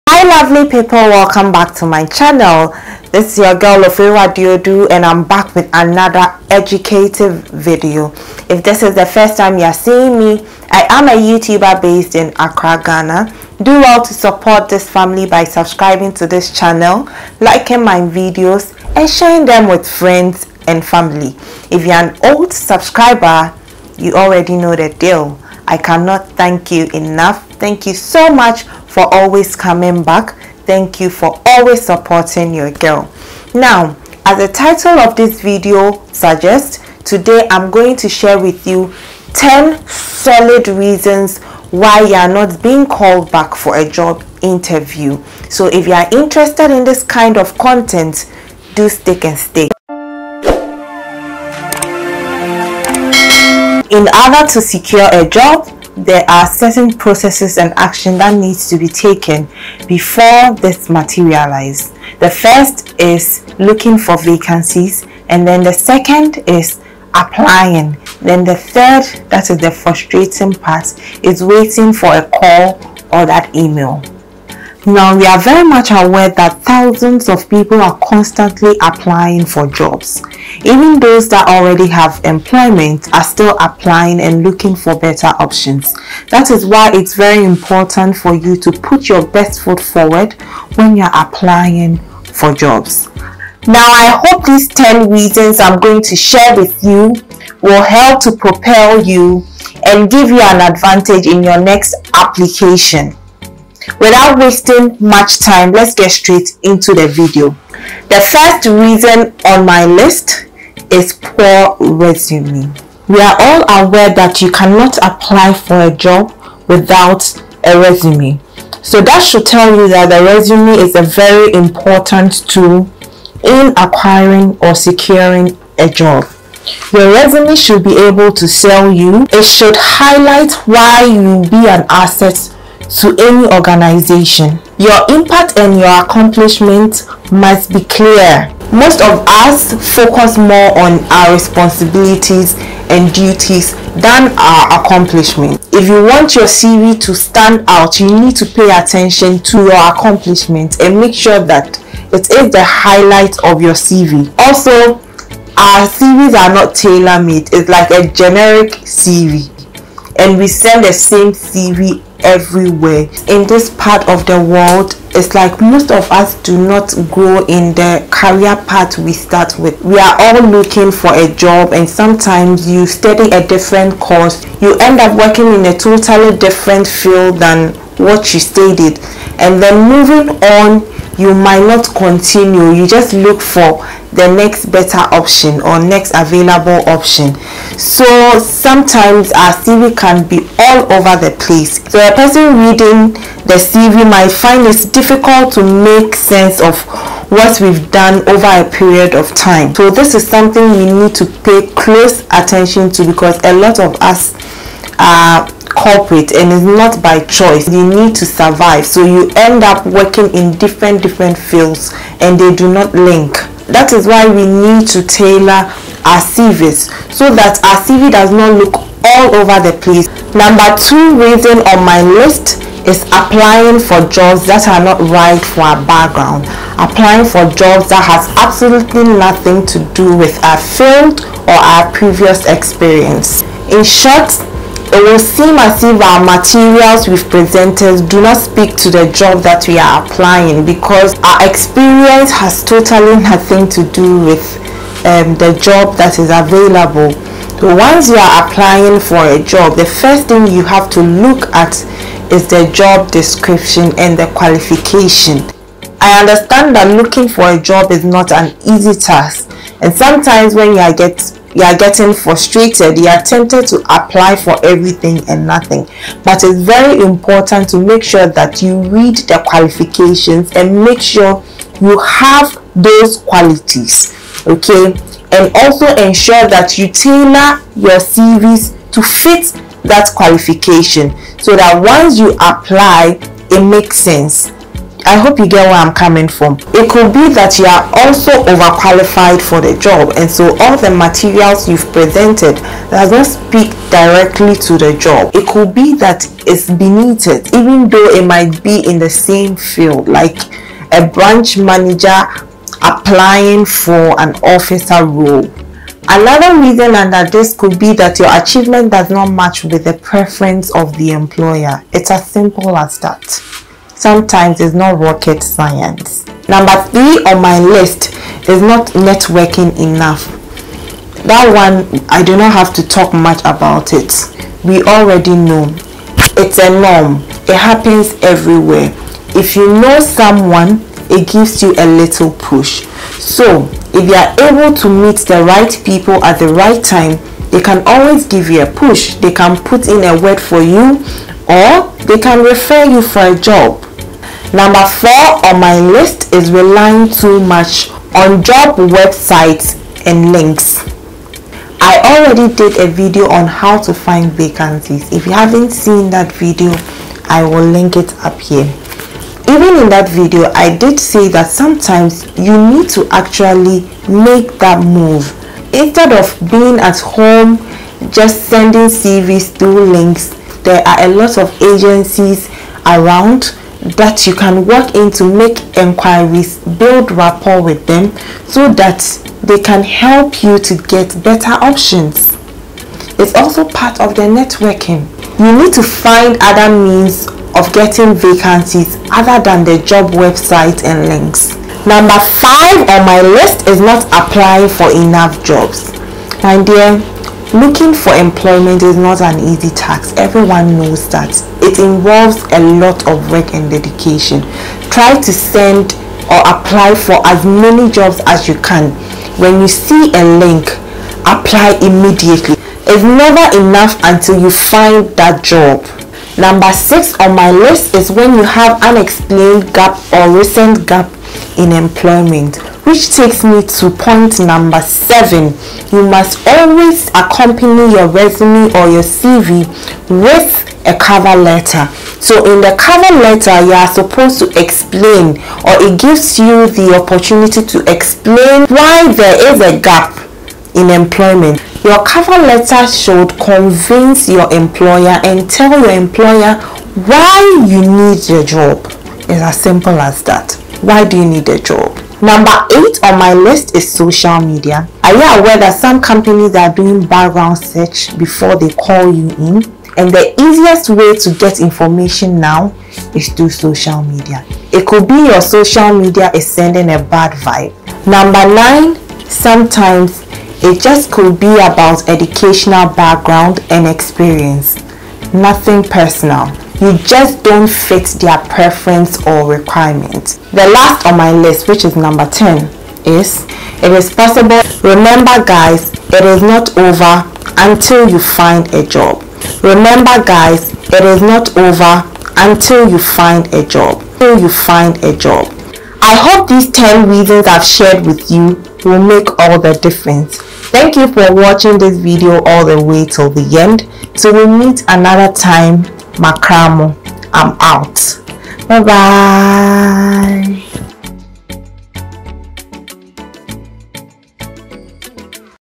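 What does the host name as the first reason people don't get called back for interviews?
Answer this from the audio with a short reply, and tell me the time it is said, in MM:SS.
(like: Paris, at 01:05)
Poor resume, at 01:51.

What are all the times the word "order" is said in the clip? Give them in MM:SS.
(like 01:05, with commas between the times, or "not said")
00:54.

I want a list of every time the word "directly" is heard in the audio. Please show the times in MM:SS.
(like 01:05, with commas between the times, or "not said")
04:53.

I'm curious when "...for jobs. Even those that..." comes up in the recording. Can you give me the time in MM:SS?
01:19.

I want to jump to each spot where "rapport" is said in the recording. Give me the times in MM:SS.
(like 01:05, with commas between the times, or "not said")
06:17.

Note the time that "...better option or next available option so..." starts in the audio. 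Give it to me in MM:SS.
03:04.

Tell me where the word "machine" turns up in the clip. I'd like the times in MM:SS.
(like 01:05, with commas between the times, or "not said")
not said.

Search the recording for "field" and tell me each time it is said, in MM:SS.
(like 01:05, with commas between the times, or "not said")
02:56, 03:31, 03:50, 04:59.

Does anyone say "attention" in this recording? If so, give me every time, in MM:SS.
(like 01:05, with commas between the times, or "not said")
02:28, 03:22.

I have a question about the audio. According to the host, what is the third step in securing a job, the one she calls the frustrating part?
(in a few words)
Waiting.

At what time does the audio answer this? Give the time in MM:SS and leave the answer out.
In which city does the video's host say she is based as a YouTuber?
00:12.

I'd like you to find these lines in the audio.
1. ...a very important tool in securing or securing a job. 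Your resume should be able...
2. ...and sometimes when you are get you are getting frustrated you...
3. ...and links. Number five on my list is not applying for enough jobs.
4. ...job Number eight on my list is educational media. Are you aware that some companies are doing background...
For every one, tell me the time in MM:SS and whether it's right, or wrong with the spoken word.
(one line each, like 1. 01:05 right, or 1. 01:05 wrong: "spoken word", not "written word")
1. 02:00 wrong: "acquiring", not "securing"
2. 04:19 right
3. 06:30 right
4. 07:31 wrong: "social", not "educational".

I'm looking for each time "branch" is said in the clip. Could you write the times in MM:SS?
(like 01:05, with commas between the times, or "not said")
05:01.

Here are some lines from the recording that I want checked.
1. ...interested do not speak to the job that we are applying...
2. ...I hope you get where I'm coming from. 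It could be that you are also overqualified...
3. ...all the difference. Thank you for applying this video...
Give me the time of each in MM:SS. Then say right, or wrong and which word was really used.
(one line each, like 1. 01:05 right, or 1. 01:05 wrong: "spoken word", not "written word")
1. 03:57 wrong: "presented", not "interested"
2. 04:45 right
3. 08:19 wrong: "watching", not "applying".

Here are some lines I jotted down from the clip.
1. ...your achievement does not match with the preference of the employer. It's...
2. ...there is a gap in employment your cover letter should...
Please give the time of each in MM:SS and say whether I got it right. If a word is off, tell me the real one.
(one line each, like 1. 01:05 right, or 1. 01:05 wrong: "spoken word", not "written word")
1. 05:08 right
2. 07:19 right.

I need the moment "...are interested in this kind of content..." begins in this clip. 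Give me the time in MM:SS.
00:45.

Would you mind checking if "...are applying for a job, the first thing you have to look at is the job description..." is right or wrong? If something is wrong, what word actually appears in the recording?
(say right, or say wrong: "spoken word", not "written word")
right.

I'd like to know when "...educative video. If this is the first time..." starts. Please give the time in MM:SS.
00:06.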